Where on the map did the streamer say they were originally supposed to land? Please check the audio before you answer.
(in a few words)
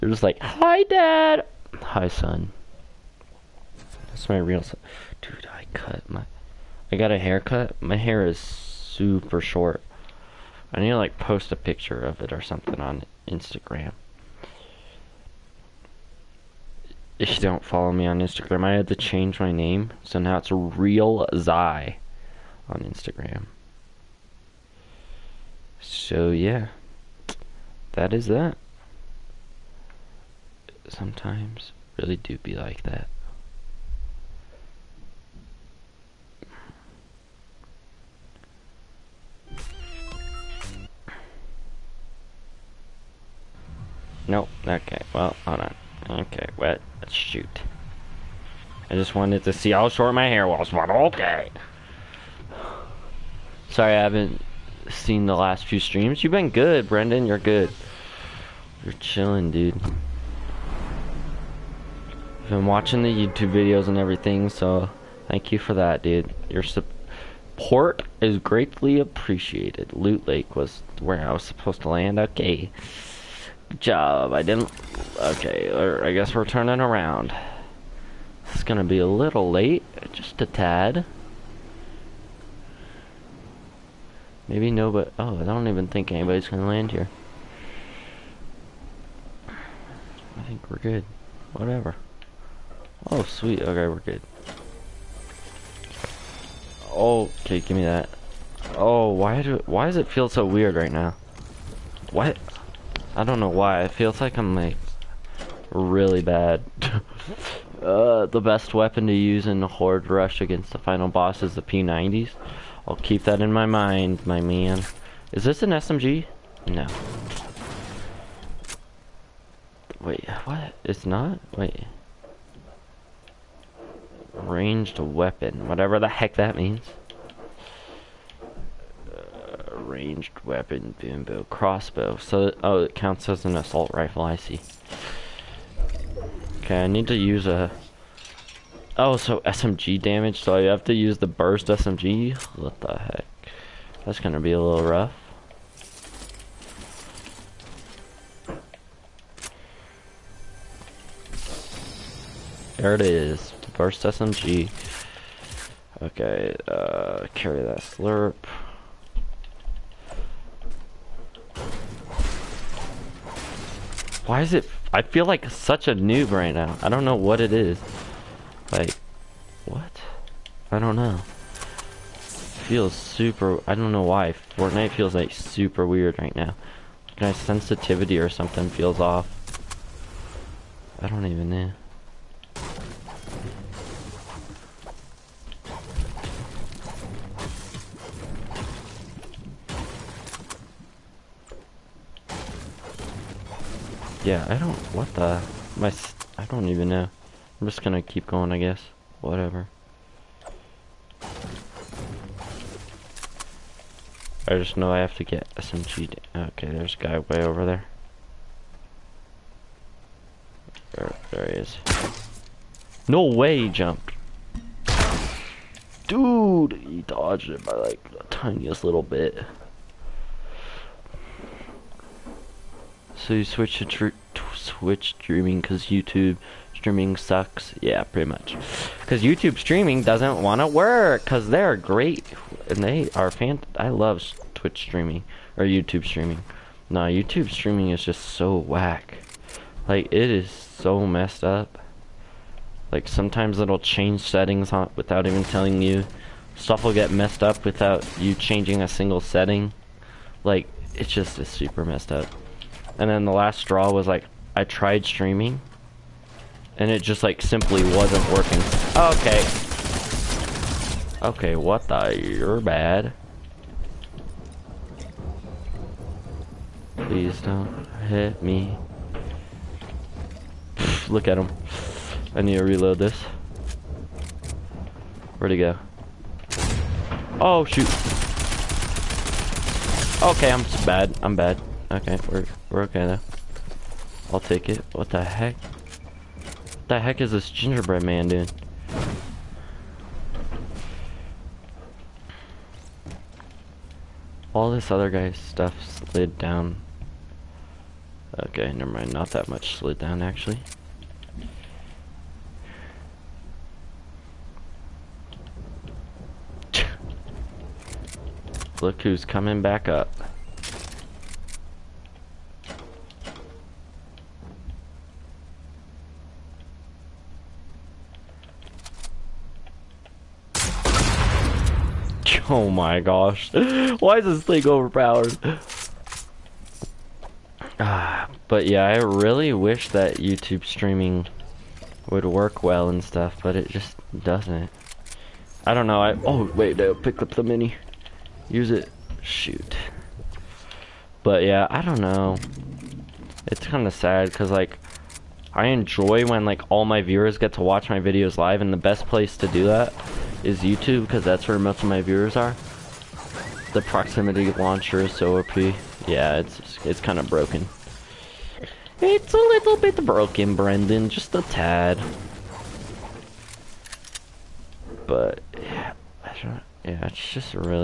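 Loot Lake.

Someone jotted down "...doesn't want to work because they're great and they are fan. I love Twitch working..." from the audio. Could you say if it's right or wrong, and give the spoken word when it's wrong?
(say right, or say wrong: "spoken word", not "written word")
wrong: "streaming", not "working".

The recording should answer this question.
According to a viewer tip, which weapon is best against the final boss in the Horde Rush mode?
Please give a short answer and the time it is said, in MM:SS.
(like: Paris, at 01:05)
P90s, at 01:51.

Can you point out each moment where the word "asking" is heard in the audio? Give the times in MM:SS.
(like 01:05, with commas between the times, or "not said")
not said.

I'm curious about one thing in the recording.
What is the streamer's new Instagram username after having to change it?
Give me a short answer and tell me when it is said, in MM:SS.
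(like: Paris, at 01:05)
Real Zai, at 00:20.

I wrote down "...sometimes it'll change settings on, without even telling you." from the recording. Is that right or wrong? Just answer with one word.
right.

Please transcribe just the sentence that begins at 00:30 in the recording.
Sometimes really do be like that.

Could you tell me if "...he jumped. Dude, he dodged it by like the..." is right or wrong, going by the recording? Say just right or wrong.
right.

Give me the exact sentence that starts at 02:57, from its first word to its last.
My sensitivity or something feels off.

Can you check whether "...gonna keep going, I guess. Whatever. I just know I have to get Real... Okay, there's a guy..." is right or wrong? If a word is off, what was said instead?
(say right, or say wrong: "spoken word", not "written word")
wrong: "SMG", not "Real".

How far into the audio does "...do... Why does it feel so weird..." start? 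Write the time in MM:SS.
01:39.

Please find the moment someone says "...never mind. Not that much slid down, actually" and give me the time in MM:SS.
04:58.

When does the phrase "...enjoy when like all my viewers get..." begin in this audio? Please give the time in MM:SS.
05:45.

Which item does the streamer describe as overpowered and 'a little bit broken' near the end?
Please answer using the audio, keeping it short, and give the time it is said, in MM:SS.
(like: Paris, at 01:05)
proximity launcher, at 05:53.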